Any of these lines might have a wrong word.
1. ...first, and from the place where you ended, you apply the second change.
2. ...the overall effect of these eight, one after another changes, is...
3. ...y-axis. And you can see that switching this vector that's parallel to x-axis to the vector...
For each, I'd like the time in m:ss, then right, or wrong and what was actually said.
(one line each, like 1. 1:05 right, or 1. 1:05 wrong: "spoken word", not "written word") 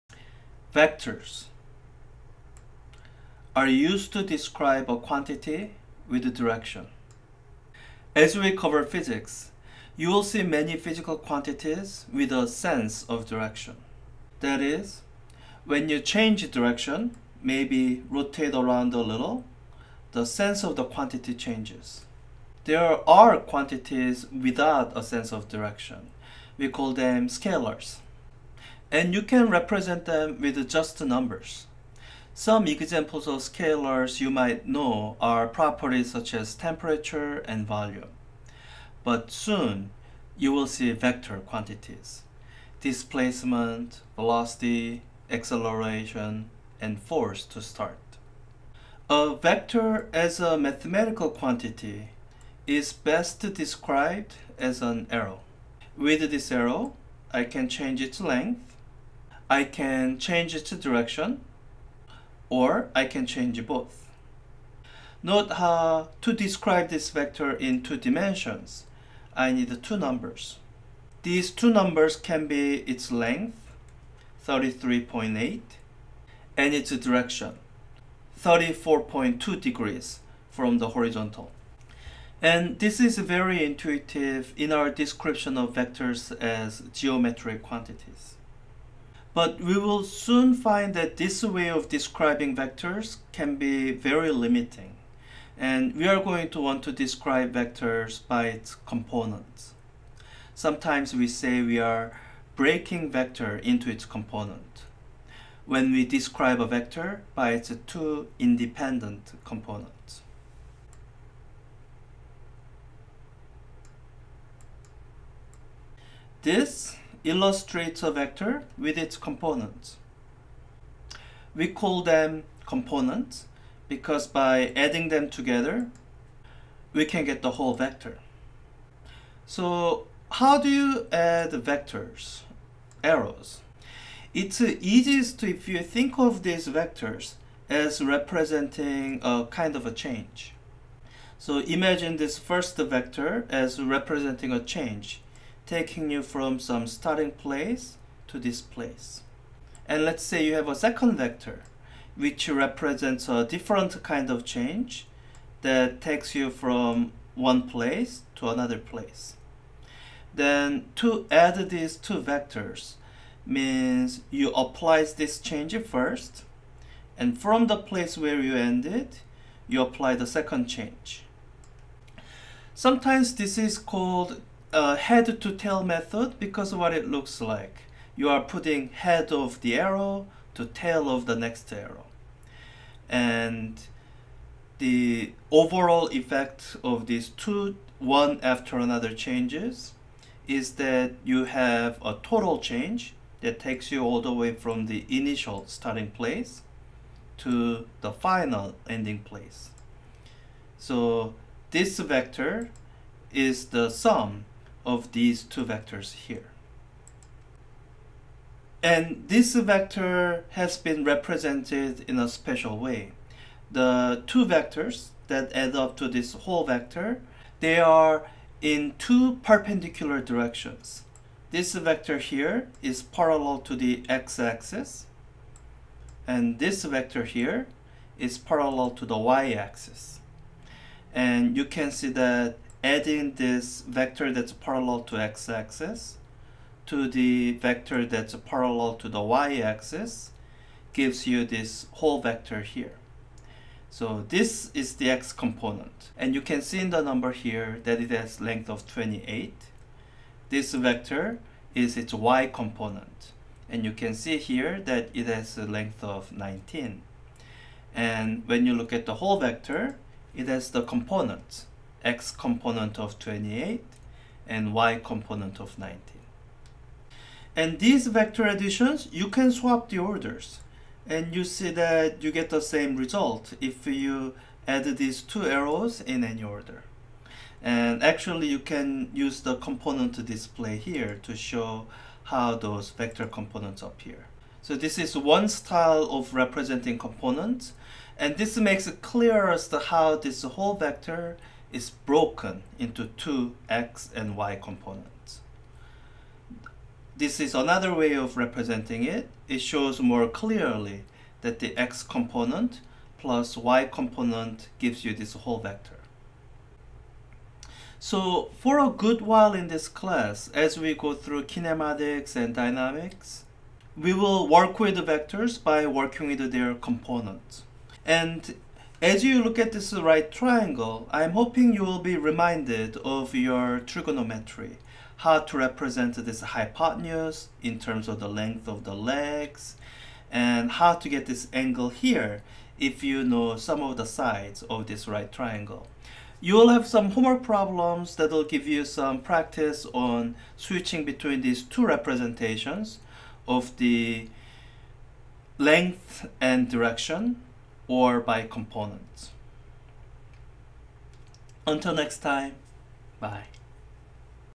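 1. 2:45 right
2. 3:04 wrong: "two", not "eight"
3. 3:49 wrong: "adding", not "switching".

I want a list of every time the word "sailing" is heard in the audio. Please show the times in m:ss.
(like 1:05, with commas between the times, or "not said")
not said.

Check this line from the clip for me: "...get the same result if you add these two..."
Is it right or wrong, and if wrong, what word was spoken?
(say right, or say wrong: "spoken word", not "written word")
right.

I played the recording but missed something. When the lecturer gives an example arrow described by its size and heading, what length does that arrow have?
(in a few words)
33.8.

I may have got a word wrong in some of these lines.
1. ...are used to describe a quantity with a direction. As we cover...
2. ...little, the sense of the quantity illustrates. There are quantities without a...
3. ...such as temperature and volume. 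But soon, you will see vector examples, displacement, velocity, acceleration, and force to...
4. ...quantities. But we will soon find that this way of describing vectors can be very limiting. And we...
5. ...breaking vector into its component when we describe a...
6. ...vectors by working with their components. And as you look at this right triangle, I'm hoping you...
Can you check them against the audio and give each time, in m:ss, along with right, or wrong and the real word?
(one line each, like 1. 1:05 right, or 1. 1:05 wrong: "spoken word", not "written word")
1. 0:03 right
2. 0:19 wrong: "changes", not "illustrates"
3. 0:36 wrong: "quantities", not "examples"
4. 1:27 right
5. 1:42 right
6. 5:15 right.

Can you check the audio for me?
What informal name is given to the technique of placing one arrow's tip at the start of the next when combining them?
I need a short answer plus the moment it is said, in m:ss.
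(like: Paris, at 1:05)
head to tail method, at 2:54.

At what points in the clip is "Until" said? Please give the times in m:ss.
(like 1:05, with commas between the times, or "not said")
5:51.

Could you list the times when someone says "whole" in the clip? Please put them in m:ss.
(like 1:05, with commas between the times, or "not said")
2:07, 3:36, 4:01, 4:19, 4:50, 5:05.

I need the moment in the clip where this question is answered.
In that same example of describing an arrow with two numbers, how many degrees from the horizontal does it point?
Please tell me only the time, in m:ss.
1:18.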